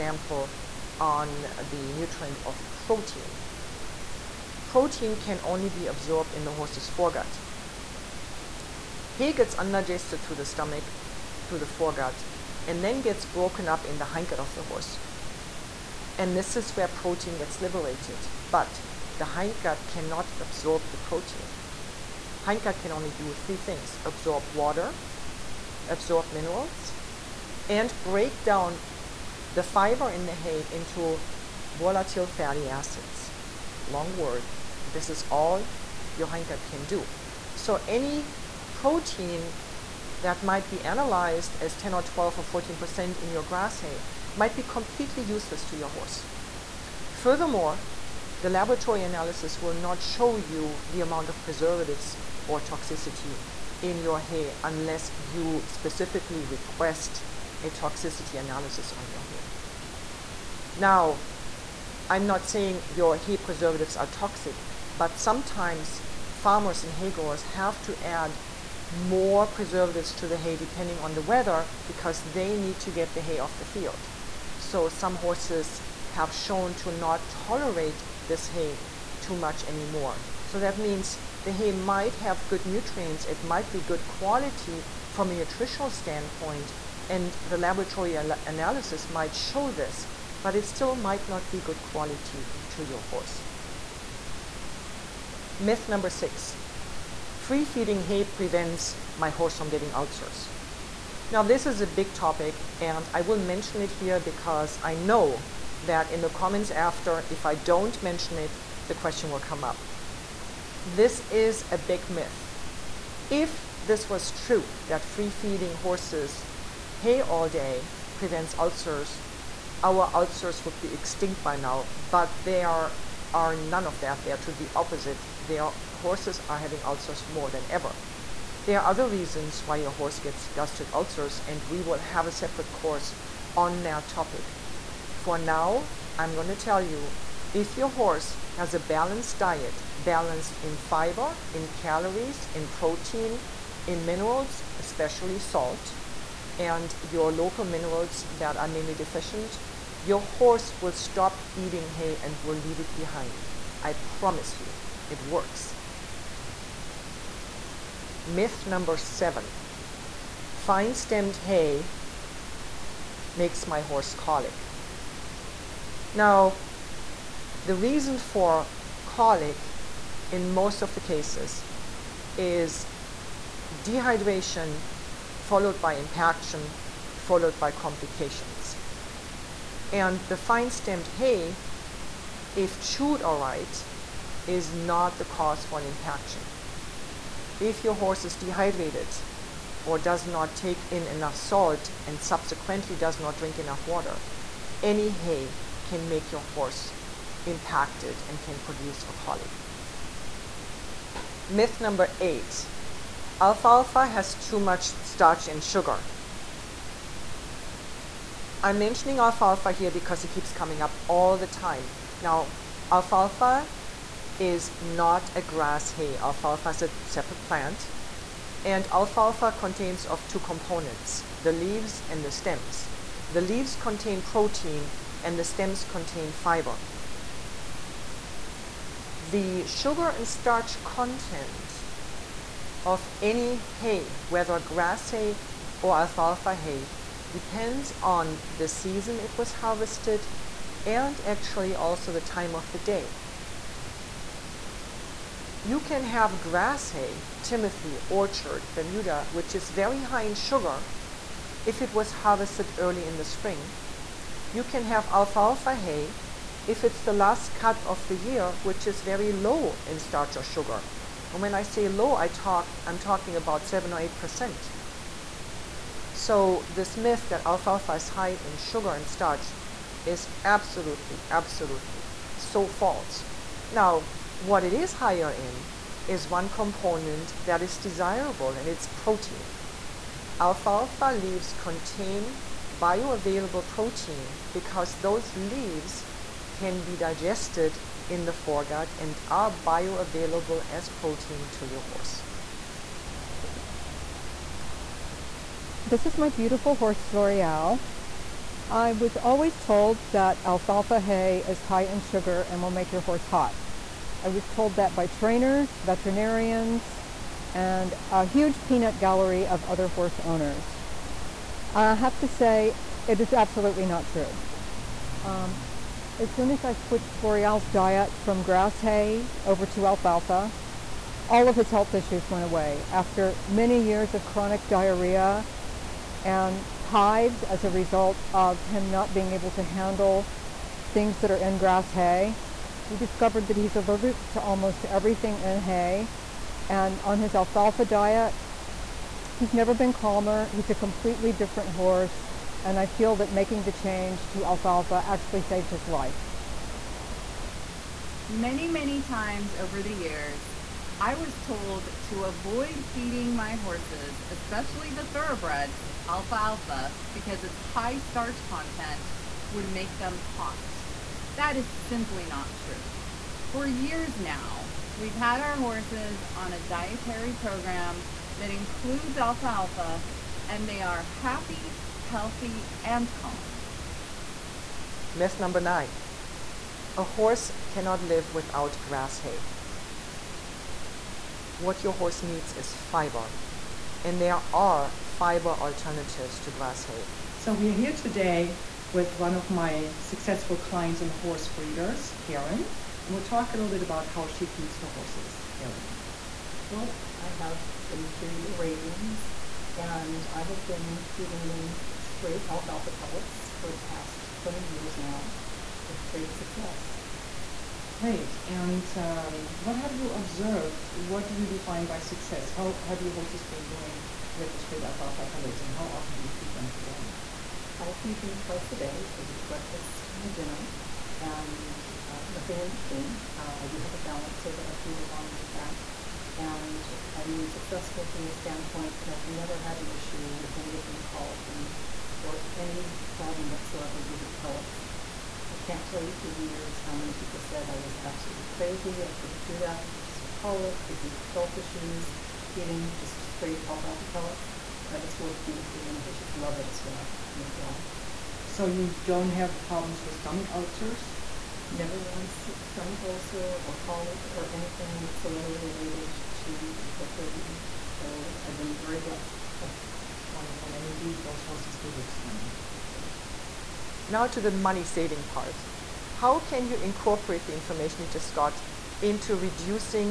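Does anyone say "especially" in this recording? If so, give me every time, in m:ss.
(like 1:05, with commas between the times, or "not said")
2:24, 5:54.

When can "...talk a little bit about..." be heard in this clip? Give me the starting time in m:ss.
6:33.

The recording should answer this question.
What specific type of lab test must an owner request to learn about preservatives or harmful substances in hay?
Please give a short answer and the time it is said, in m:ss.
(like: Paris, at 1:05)
toxicity analysis, at 0:57.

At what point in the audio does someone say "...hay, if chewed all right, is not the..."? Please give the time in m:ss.
3:01.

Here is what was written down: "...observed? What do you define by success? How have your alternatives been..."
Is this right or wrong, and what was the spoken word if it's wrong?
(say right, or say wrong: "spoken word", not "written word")
wrong: "horses", not "alternatives".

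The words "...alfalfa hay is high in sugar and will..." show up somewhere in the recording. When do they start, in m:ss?
5:00.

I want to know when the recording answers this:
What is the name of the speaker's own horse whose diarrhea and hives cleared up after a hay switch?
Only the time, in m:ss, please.
4:57.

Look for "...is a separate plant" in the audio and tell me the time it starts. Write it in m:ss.
3:36.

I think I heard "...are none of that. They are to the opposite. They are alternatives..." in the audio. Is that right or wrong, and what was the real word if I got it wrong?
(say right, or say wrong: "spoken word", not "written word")
wrong: "horses", not "alternatives".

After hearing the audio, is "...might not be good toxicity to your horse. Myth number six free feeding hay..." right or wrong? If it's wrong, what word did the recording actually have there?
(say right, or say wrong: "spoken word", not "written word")
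wrong: "quality", not "toxicity".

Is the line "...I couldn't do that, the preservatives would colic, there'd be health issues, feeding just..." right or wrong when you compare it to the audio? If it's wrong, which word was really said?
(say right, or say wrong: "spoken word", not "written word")
wrong: "horses", not "preservatives".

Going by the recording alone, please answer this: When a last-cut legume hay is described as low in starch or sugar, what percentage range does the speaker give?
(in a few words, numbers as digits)
7 or 8%.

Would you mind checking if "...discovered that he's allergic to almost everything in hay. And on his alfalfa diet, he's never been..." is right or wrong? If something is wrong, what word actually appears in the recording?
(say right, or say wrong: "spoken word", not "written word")
right.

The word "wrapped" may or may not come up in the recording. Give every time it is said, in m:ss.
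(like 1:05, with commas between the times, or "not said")
not said.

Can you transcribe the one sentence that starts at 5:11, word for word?
I have to say, it is absolutely not true.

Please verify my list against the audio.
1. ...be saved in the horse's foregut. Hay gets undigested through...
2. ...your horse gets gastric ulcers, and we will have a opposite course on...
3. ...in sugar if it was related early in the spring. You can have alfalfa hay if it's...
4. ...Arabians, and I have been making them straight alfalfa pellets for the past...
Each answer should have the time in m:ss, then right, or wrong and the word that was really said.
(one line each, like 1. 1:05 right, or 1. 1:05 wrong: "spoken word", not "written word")
1. 0:05 wrong: "absorbed", not "saved"
2. 2:09 wrong: "separate", not "opposite"
3. 4:10 wrong: "harvested", not "related"
4. 6:38 wrong: "feeding", not "making".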